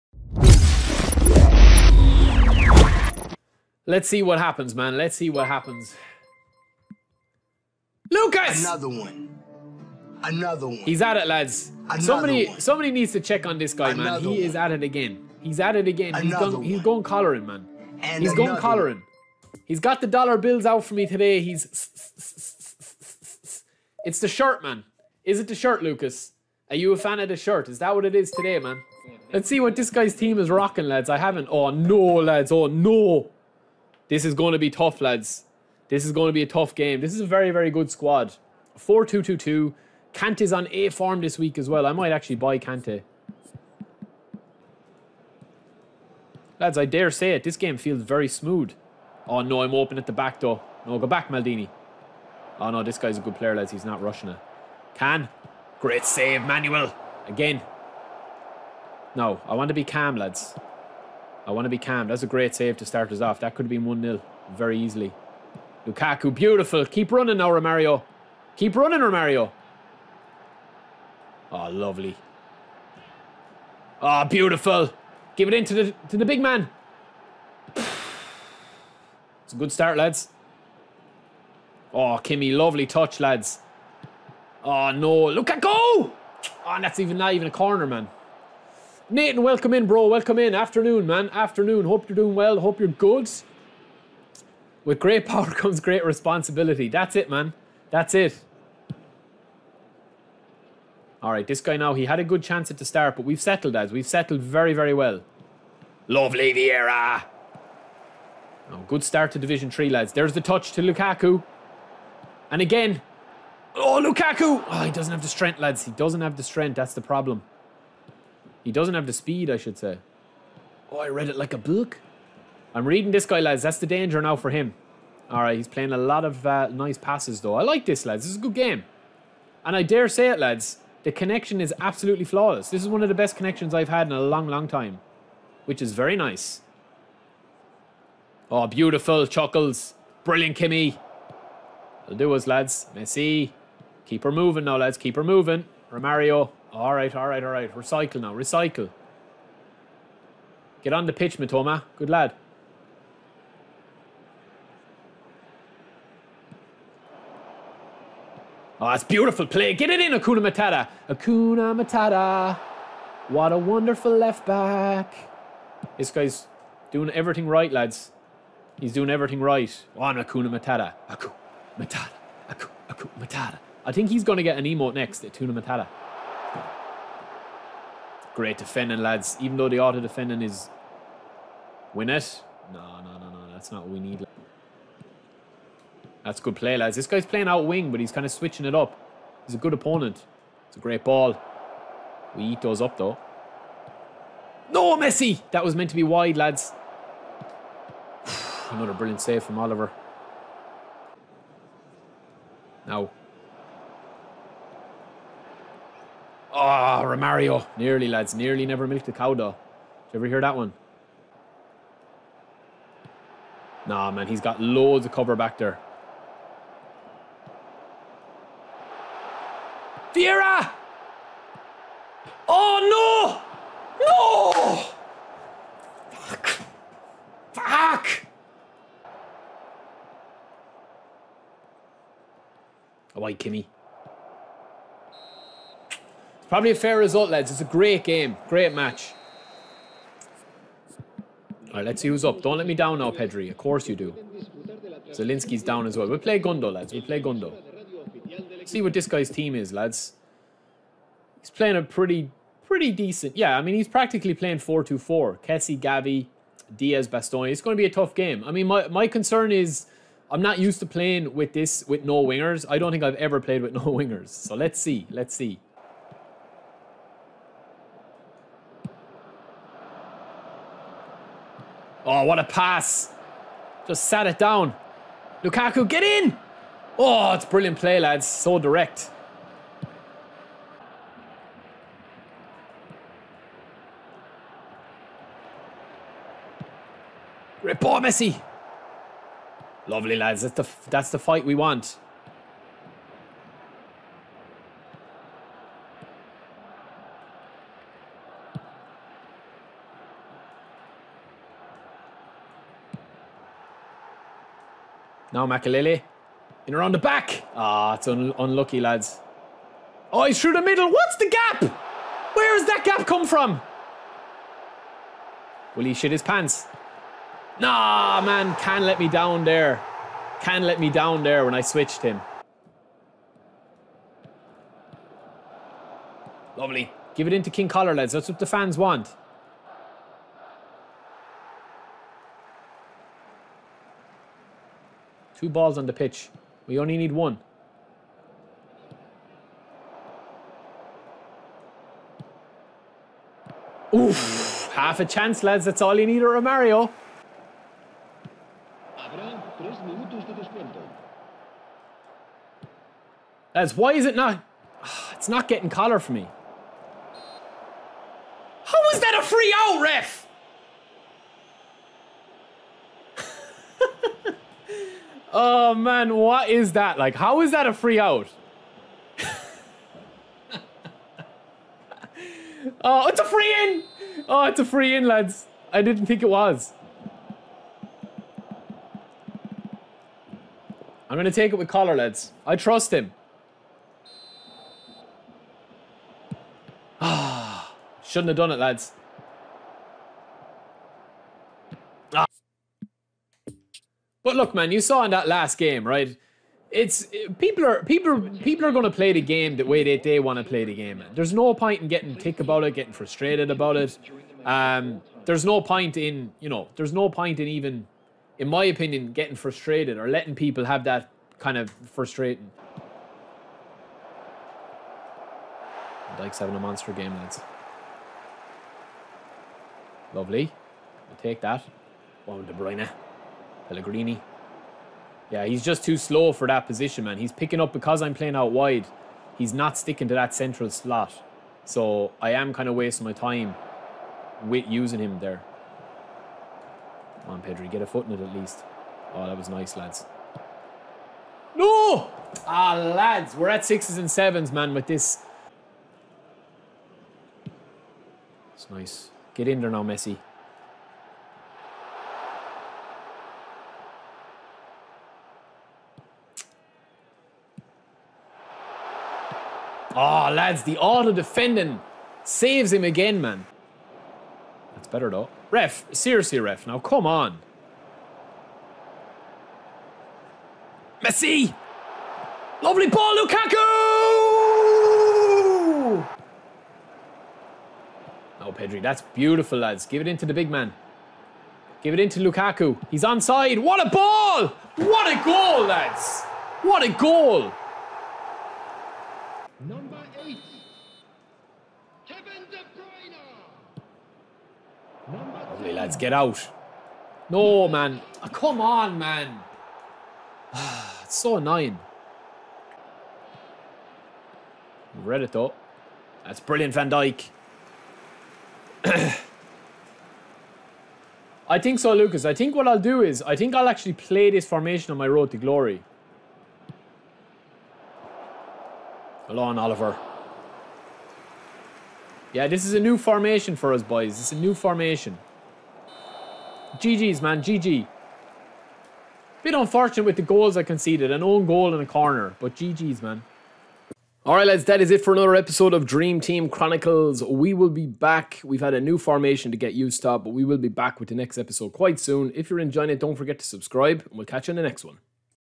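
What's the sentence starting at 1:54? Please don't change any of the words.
Oh, he doesn't have the strength, lads.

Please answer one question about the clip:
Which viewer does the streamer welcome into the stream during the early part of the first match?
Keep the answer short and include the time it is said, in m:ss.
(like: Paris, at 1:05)
Nathan, at 1:29.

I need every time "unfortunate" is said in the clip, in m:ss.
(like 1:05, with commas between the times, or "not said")
8:49.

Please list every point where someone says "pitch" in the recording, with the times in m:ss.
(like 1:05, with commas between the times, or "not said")
2:31, 5:35.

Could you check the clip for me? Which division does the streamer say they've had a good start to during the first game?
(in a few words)
Division 3.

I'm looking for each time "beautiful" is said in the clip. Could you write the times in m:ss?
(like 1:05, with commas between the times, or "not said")
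1:06, 1:14, 2:18, 2:39, 7:59.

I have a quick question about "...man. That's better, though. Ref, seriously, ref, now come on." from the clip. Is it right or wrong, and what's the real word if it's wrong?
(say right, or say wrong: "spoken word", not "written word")
right.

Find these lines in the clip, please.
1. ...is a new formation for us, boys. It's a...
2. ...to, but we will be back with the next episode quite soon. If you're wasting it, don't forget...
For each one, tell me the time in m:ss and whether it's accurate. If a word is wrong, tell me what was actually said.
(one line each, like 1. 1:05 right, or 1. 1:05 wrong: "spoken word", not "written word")
1. 8:42 right
2. 9:00 wrong: "enjoying", not "wasting".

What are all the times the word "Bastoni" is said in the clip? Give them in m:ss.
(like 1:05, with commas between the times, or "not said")
4:17.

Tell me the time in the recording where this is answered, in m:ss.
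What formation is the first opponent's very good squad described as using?
0:38.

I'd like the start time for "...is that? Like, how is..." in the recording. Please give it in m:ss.
6:06.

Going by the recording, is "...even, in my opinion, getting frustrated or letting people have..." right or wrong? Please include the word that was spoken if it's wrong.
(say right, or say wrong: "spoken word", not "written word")
right.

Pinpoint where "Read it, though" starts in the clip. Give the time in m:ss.
8:25.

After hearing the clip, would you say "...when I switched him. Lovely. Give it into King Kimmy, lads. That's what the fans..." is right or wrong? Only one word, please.
wrong.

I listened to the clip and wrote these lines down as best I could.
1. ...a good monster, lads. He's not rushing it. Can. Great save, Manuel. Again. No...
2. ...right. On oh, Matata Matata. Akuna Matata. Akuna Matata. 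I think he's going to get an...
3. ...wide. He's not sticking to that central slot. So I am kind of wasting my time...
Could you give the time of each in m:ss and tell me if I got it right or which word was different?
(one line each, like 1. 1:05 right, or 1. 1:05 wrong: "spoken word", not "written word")
1. 0:53 wrong: "player", not "monster"
2. 2:49 wrong: "Akuna", not "Matata"
3. 7:08 right.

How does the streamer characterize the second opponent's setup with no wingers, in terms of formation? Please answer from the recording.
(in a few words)
4-2-4.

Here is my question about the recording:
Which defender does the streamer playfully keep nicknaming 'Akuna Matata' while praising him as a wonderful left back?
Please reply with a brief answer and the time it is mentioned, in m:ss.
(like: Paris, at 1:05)
Matoma, at 2:31.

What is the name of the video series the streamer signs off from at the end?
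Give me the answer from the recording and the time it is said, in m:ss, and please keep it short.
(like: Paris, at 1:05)
Dream Team Chronicles, at 8:55.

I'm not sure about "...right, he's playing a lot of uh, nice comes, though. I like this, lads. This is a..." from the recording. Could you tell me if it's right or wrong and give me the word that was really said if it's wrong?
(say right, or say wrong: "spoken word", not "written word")
wrong: "passes", not "comes".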